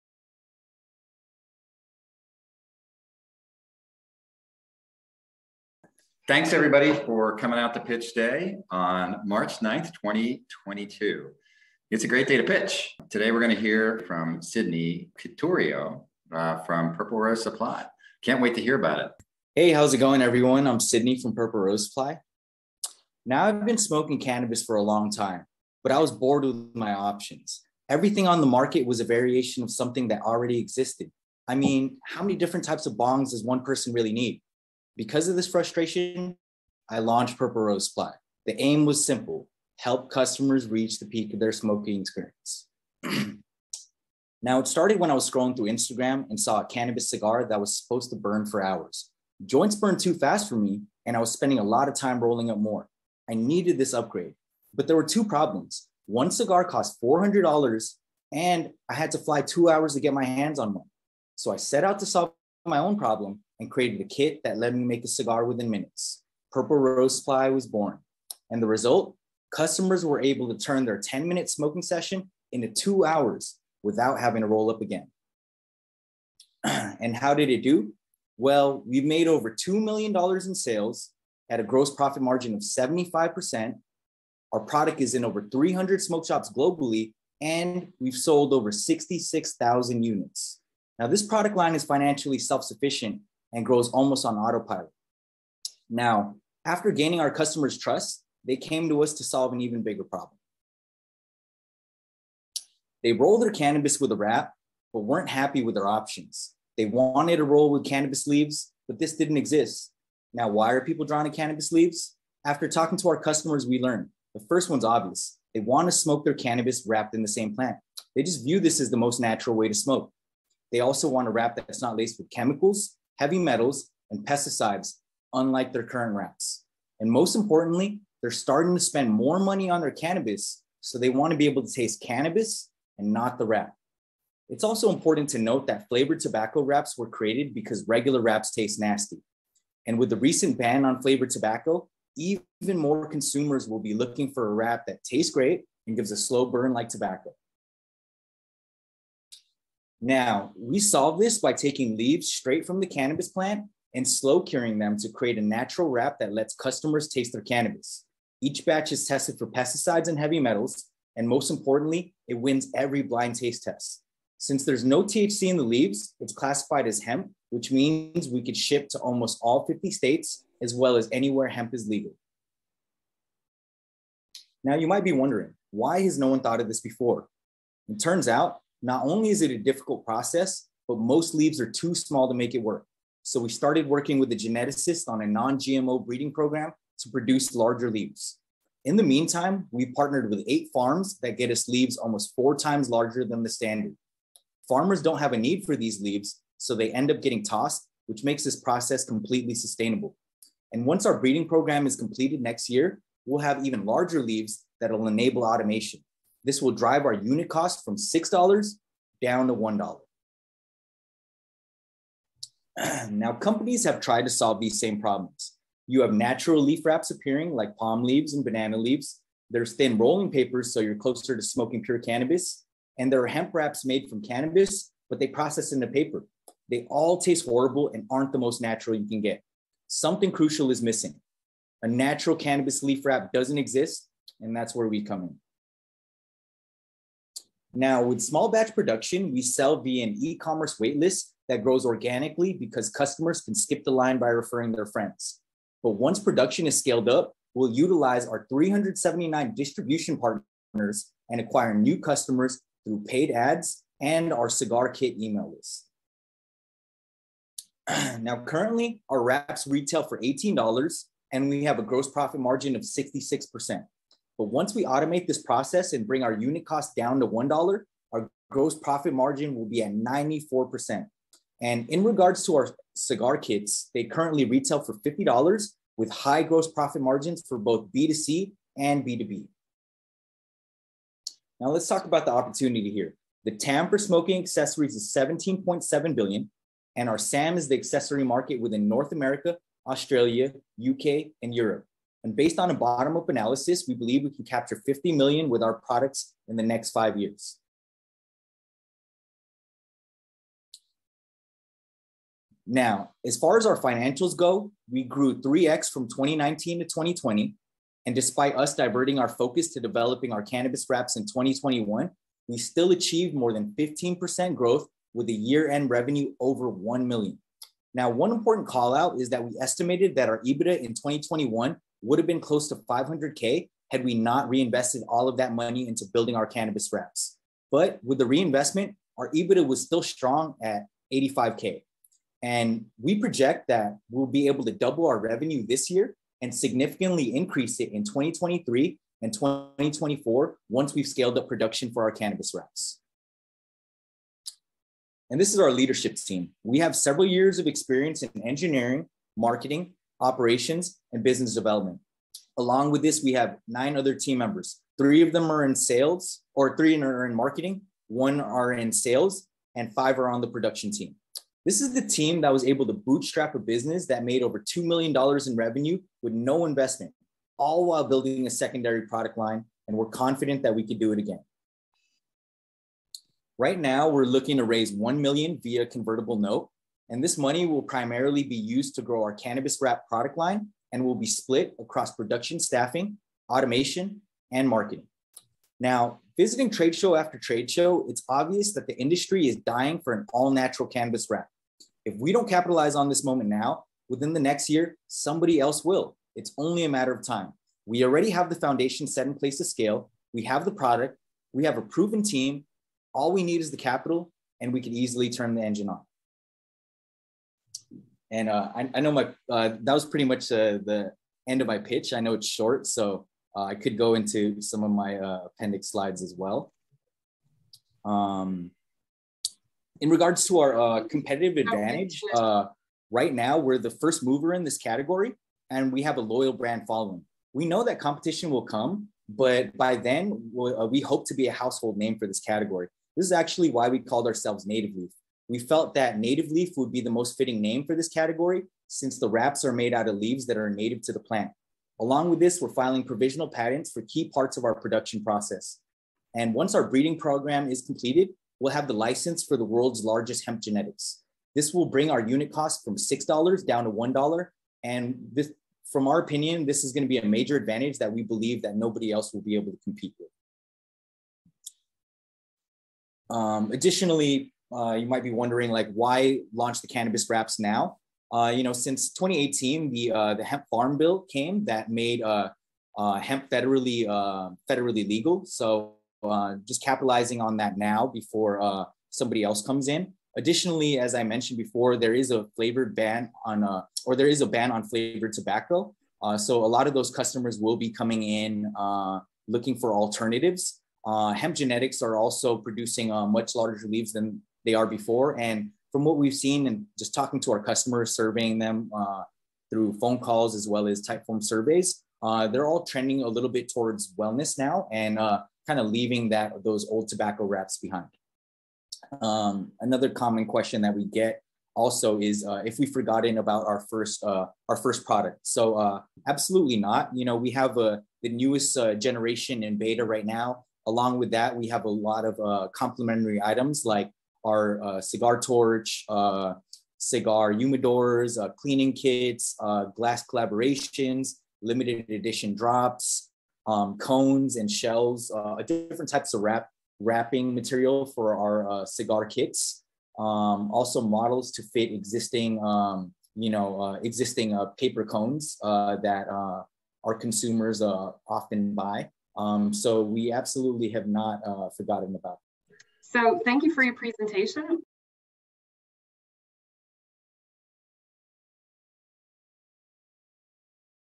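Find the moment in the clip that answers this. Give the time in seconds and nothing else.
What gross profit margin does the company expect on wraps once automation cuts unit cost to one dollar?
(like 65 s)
269 s.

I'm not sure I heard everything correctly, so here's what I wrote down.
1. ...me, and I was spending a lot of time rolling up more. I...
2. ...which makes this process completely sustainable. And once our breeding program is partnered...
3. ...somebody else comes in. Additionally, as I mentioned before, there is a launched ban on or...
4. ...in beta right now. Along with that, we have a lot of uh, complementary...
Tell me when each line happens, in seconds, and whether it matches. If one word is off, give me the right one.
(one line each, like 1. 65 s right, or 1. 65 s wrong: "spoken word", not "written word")
1. 50 s right
2. 198 s wrong: "completed", not "partnered"
3. 479 s wrong: "flavored", not "launched"
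4. 519 s right.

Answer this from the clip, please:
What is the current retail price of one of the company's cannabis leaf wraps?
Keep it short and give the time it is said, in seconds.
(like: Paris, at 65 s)
$18, at 260 s.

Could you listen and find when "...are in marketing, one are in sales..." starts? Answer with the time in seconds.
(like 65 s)
357 s.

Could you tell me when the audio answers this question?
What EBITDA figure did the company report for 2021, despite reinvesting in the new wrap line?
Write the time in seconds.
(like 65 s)
331 s.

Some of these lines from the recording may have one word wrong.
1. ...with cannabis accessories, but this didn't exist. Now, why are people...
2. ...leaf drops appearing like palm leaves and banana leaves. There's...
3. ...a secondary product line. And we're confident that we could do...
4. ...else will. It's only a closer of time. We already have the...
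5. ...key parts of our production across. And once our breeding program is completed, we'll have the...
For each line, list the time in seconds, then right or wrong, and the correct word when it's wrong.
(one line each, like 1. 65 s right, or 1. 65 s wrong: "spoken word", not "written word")
1. 107 s wrong: "leaves", not "accessories"
2. 216 s wrong: "wraps", not "drops"
3. 368 s right
4. 395 s wrong: "matter", not "closer"
5. 444 s wrong: "process", not "across".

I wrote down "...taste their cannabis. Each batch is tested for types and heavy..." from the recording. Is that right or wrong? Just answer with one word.
wrong.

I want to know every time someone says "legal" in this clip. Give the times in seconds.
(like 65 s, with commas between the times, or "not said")
171 s, 475 s.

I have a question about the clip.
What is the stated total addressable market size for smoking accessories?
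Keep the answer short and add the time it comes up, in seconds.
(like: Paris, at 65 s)
17.7 billion, at 285 s.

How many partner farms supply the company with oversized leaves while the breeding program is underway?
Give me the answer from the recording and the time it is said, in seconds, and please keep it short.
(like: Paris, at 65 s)
8, at 190 s.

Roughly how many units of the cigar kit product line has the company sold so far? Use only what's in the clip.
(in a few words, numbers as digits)
66,000.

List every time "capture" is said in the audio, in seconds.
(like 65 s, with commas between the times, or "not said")
294 s.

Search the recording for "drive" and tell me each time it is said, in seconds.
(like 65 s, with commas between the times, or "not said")
206 s.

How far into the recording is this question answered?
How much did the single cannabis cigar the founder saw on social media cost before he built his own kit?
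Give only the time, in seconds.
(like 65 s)
57 s.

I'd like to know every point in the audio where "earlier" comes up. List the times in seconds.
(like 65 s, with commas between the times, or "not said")
not said.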